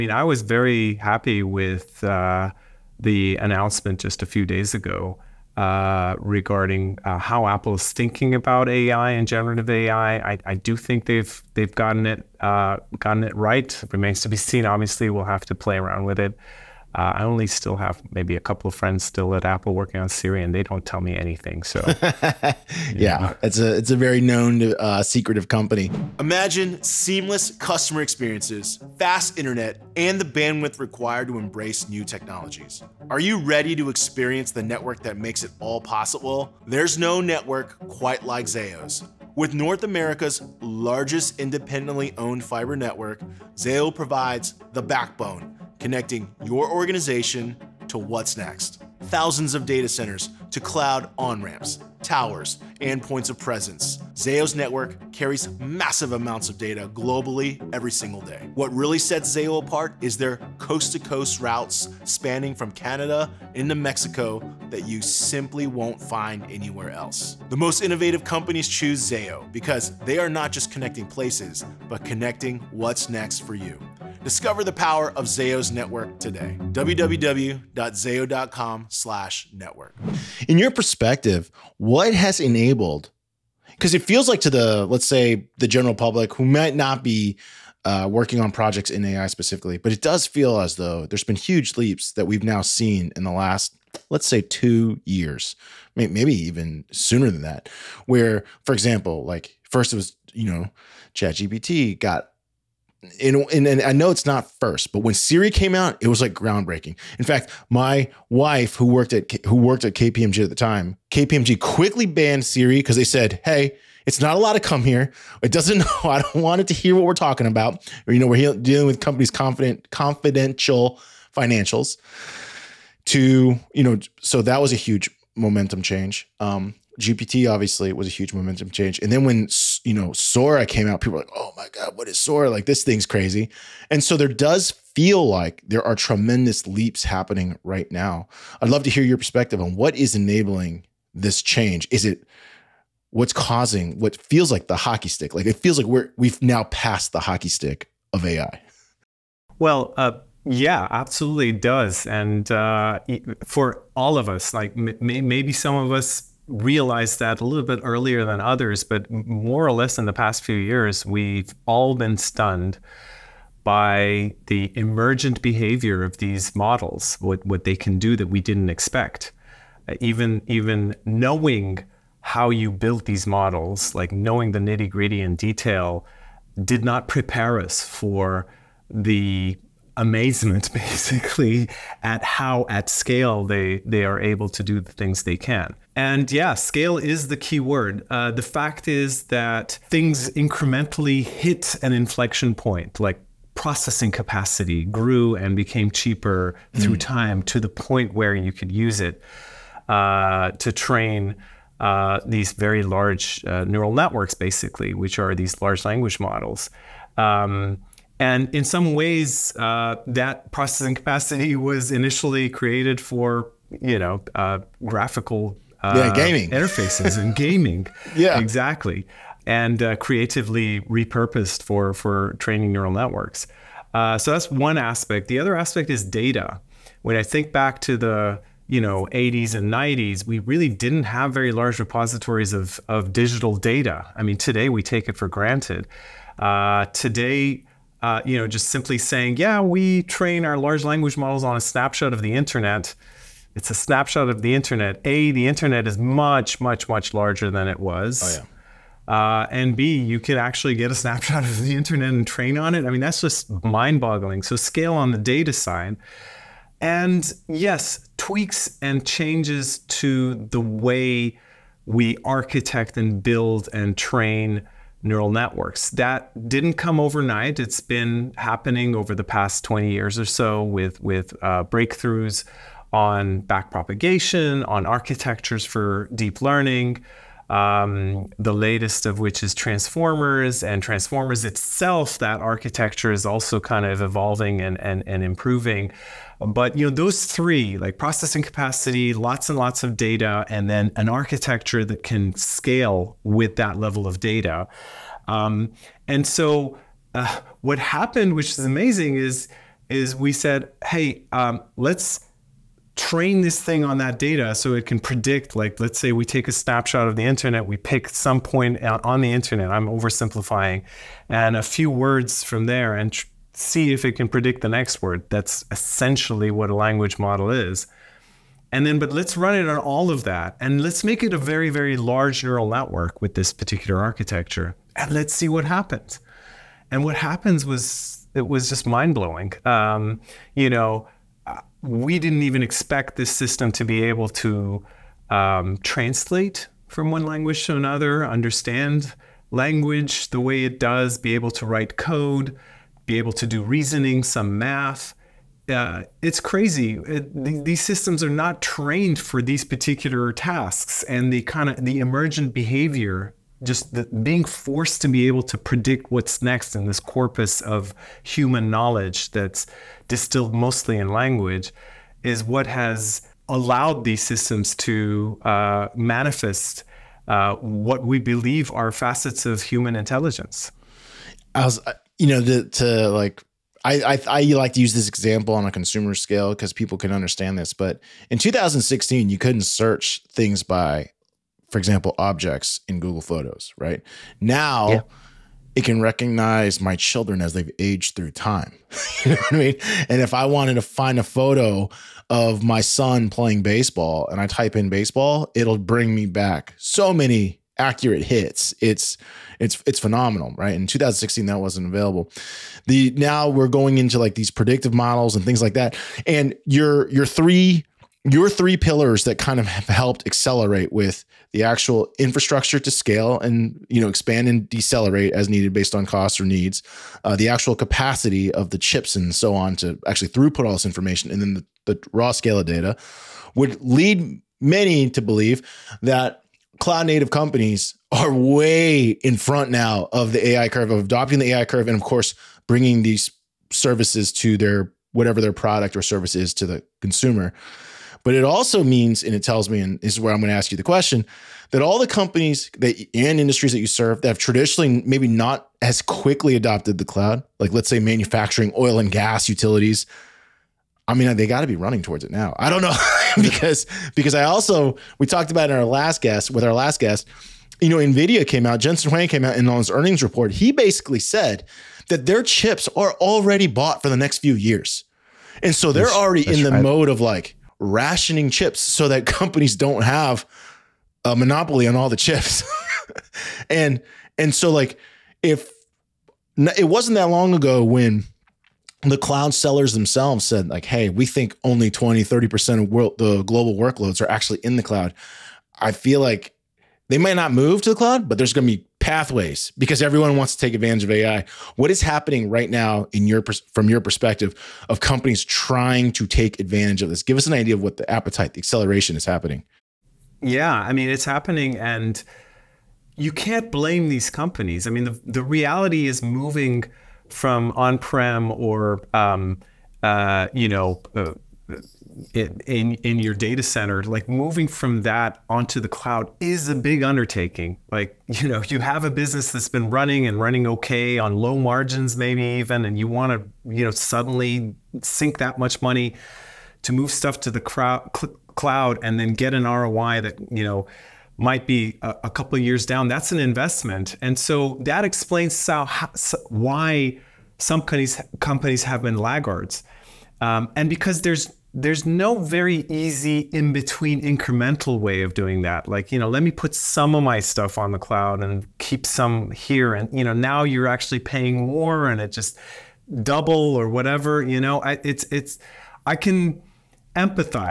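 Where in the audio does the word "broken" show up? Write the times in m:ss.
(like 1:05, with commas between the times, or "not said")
not said.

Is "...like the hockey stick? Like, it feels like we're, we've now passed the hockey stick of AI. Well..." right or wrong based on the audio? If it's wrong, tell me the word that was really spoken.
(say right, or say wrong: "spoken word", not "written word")
right.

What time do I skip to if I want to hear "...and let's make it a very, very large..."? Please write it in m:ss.
5:20.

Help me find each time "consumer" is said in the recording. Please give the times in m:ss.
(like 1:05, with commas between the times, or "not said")
6:15, 7:16.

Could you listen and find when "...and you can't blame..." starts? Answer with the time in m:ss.
8:21.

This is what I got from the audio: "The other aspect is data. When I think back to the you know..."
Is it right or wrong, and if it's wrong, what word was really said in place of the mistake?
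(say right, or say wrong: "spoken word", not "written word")
right.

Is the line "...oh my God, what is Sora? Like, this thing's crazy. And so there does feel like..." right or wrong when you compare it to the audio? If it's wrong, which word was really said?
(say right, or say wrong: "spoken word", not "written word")
right.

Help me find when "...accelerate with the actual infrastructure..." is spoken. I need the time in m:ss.
6:50.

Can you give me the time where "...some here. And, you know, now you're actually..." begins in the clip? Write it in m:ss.
9:09.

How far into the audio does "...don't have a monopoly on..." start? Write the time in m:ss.
7:49.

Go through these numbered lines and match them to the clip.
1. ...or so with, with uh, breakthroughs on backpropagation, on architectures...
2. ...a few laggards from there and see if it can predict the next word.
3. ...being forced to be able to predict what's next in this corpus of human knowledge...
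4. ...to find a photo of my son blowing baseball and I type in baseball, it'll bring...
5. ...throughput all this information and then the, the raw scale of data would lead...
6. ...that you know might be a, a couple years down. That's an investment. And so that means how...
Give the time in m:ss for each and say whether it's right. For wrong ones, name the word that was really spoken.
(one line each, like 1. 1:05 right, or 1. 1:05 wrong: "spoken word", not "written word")
1. 4:30 right
2. 5:11 wrong: "words", not "laggards"
3. 5:54 right
4. 6:30 wrong: "playing", not "blowing"
5. 7:00 right
6. 8:50 wrong: "explains", not "means".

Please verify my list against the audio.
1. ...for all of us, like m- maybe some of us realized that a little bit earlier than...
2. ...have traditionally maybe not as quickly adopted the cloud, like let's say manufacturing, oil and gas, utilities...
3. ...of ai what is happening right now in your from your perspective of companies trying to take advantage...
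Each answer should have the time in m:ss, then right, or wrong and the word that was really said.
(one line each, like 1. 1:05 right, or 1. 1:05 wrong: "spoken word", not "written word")
1. 2:33 right
2. 7:24 right
3. 8:11 right.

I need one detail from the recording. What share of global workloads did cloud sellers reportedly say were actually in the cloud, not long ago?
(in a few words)
20 to 30%.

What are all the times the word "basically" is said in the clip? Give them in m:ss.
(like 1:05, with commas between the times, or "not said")
3:00, 3:24, 7:40.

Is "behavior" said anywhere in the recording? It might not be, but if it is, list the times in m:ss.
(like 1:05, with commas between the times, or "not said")
2:45, 5:52.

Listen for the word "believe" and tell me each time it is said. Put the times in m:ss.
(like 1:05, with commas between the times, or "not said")
6:08, 7:05.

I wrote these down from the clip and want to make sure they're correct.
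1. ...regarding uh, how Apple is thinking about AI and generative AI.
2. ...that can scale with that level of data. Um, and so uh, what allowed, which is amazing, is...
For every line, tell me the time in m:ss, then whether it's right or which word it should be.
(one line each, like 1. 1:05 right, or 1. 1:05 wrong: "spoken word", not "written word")
1. 0:06 right
2. 4:51 wrong: "happened", not "allowed".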